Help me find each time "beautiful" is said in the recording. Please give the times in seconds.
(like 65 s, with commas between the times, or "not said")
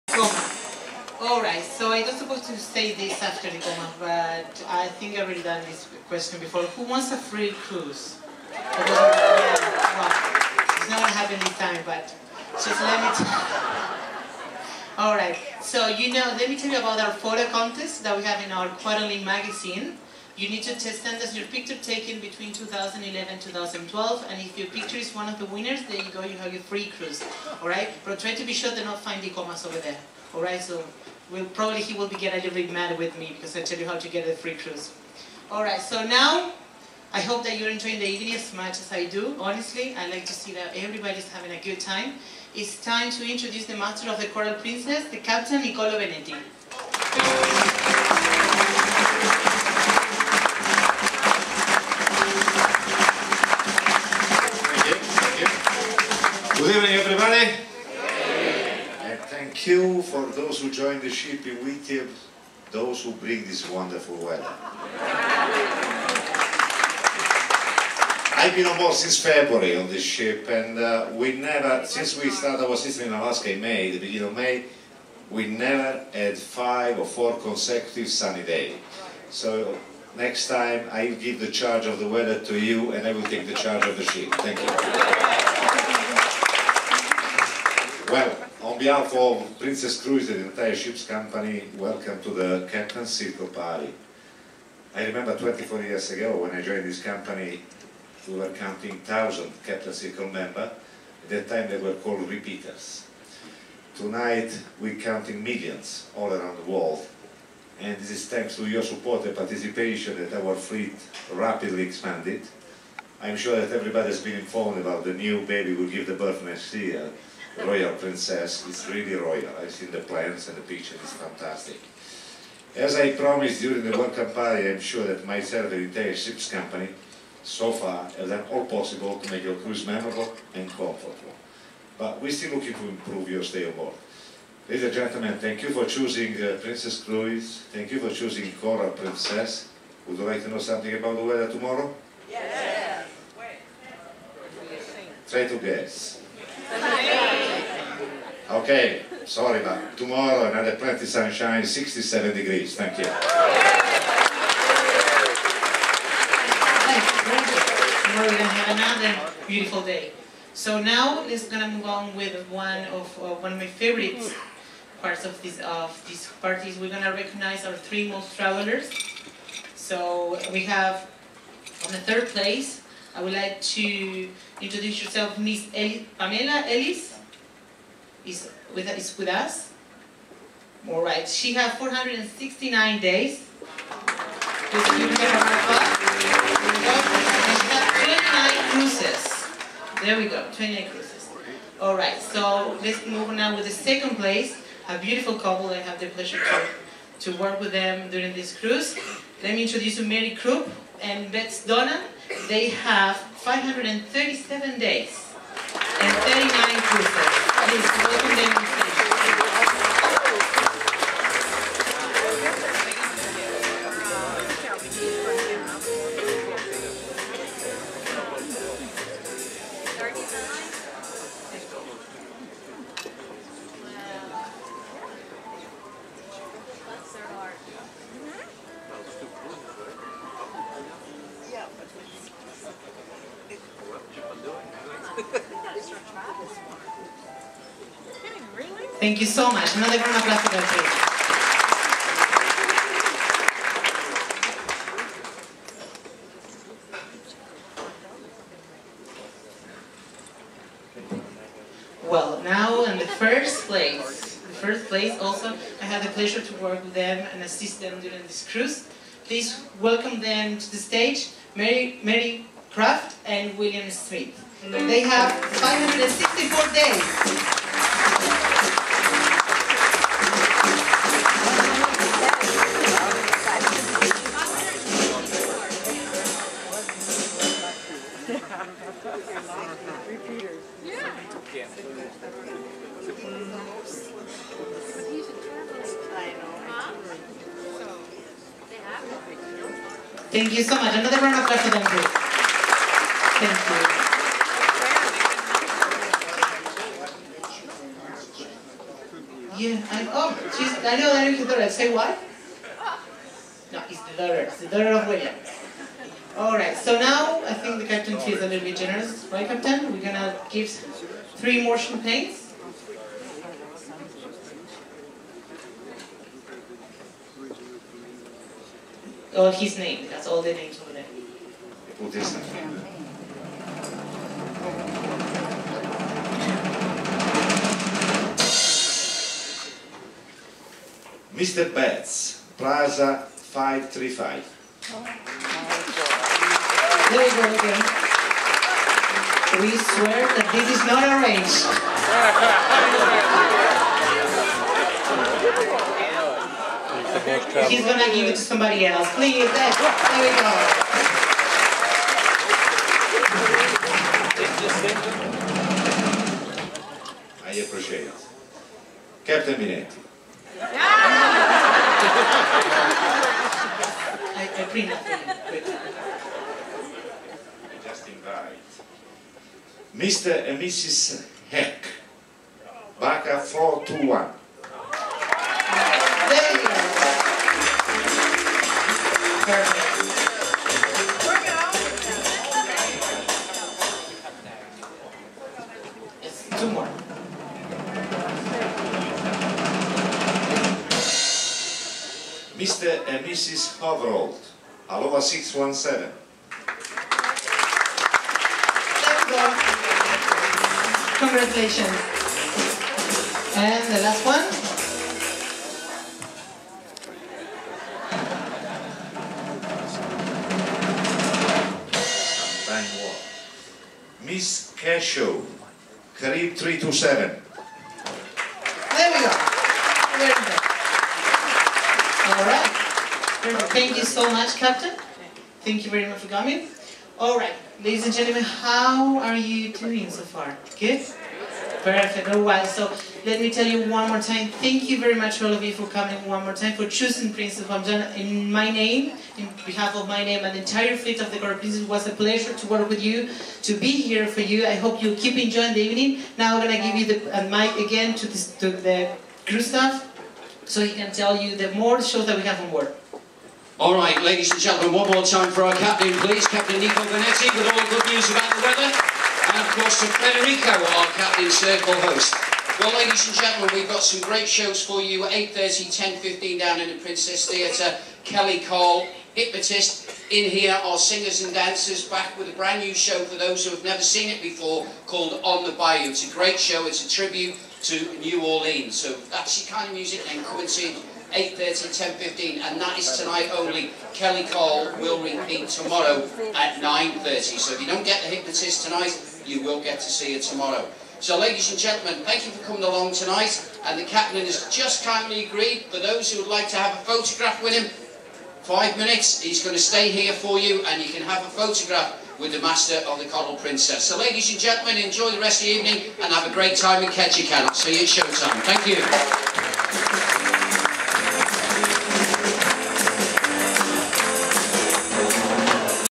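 159 s, 194 s.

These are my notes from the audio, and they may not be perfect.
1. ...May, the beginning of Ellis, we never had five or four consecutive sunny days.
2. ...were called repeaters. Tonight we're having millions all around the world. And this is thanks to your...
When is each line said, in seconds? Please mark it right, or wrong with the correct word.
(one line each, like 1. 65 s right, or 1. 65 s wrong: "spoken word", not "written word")
1. 73 s wrong: "May", not "Ellis"
2. 101 s wrong: "counting", not "having".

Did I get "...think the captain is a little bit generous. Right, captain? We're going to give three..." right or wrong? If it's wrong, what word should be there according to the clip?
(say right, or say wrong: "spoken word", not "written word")
right.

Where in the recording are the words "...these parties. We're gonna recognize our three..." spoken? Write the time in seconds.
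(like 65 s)
166 s.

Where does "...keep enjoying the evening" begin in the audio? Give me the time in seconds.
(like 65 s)
445 s.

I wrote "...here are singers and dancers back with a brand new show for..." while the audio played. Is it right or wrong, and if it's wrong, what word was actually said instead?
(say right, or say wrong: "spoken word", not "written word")
right.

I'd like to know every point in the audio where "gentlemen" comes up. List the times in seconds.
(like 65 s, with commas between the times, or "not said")
134 s, 428 s, 454 s, 463 s, 491 s, 504 s.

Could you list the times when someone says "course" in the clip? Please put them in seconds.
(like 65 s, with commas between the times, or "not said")
459 s.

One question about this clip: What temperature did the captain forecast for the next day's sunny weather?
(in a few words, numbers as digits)
67 degrees.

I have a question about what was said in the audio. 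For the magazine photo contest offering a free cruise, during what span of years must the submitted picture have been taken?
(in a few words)
2011 and 2012.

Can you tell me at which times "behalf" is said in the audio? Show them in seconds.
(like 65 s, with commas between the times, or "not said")
88 s, 439 s.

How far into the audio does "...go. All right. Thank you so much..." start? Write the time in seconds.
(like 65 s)
422 s.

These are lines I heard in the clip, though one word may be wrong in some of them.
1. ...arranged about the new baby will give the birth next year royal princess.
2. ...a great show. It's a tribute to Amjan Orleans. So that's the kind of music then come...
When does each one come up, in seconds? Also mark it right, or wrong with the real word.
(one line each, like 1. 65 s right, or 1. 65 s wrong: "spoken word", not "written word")
1. 114 s wrong: "informed", not "arranged"
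2. 476 s wrong: "New", not "Amjan".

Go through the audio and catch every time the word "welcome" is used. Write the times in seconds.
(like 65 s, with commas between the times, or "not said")
91 s, 259 s.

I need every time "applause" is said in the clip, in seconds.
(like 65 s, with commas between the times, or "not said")
240 s, 291 s.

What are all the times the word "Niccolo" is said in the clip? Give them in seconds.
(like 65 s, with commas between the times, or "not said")
45 s.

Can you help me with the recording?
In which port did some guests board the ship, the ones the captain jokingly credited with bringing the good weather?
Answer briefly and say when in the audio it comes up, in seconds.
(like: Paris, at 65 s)
Whittier, at 61 s.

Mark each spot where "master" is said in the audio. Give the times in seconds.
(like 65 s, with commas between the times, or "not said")
43 s, 502 s.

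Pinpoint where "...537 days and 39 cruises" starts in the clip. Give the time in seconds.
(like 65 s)
203 s.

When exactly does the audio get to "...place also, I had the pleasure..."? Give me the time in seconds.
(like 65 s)
254 s.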